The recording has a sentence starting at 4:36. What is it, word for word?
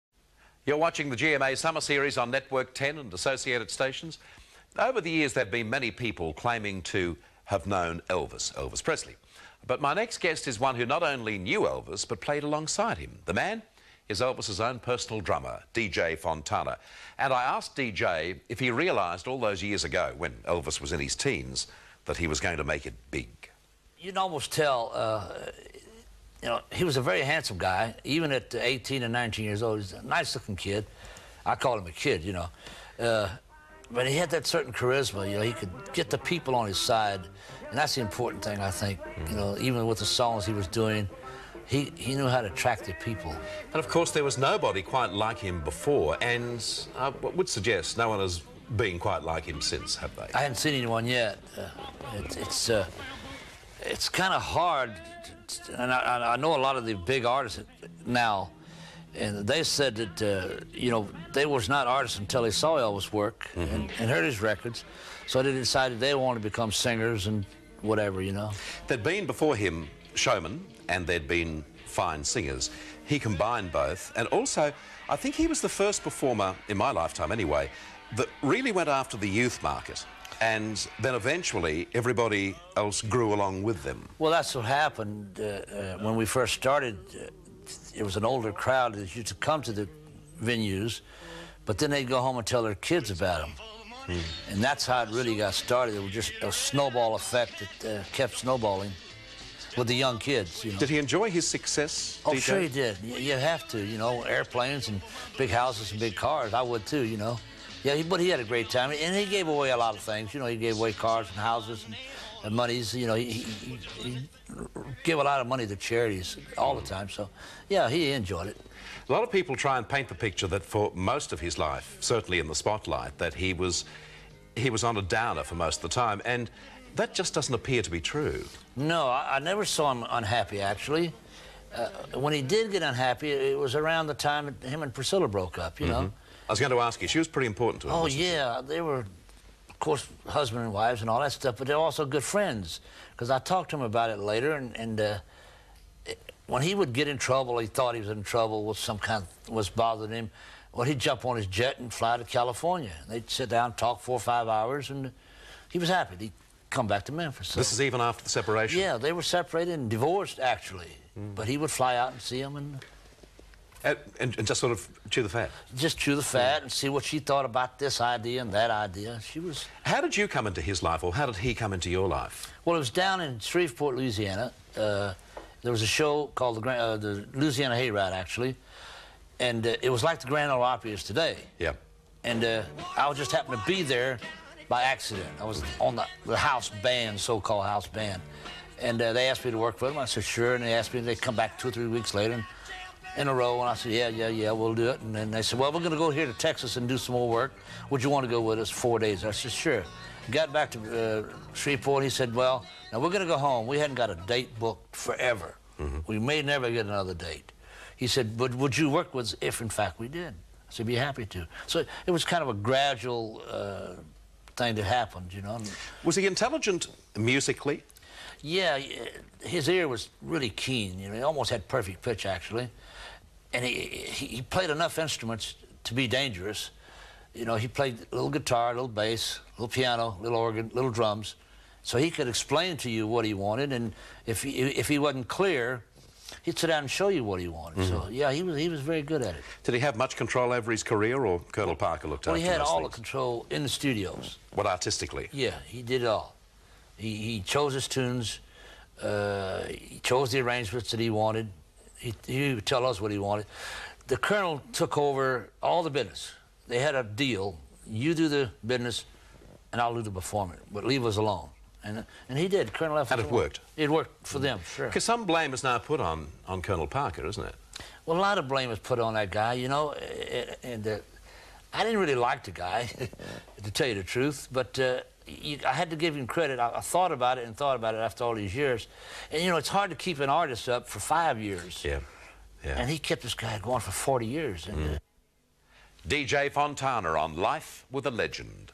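I, I, thought about it and thought about it after all these years.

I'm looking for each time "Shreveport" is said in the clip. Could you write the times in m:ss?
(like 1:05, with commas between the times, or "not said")
2:53, 3:21.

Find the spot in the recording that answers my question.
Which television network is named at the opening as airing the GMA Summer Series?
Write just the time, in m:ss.
0:02.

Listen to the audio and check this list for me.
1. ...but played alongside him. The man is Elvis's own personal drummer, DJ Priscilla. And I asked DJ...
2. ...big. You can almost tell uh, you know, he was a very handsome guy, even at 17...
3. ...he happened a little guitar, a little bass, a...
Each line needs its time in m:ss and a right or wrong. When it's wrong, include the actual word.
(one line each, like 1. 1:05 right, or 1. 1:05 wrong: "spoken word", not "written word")
1. 0:12 wrong: "Fontana", not "Priscilla"
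2. 0:23 wrong: "18", not "17"
3. 3:47 wrong: "played", not "happened".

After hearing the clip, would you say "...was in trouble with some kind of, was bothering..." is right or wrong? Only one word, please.
right.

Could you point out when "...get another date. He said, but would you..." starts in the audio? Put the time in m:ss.
3:26.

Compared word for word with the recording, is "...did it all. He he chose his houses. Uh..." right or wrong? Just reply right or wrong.
wrong.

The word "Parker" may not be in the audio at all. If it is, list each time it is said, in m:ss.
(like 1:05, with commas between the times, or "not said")
4:01, 4:26.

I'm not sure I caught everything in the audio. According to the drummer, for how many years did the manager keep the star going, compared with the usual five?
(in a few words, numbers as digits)
40 years.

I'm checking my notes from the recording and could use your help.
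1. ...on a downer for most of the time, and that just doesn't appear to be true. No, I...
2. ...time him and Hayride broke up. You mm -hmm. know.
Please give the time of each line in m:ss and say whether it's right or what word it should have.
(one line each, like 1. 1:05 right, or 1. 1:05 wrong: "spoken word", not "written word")
1. 2:04 right
2. 2:14 wrong: "Priscilla", not "Hayride".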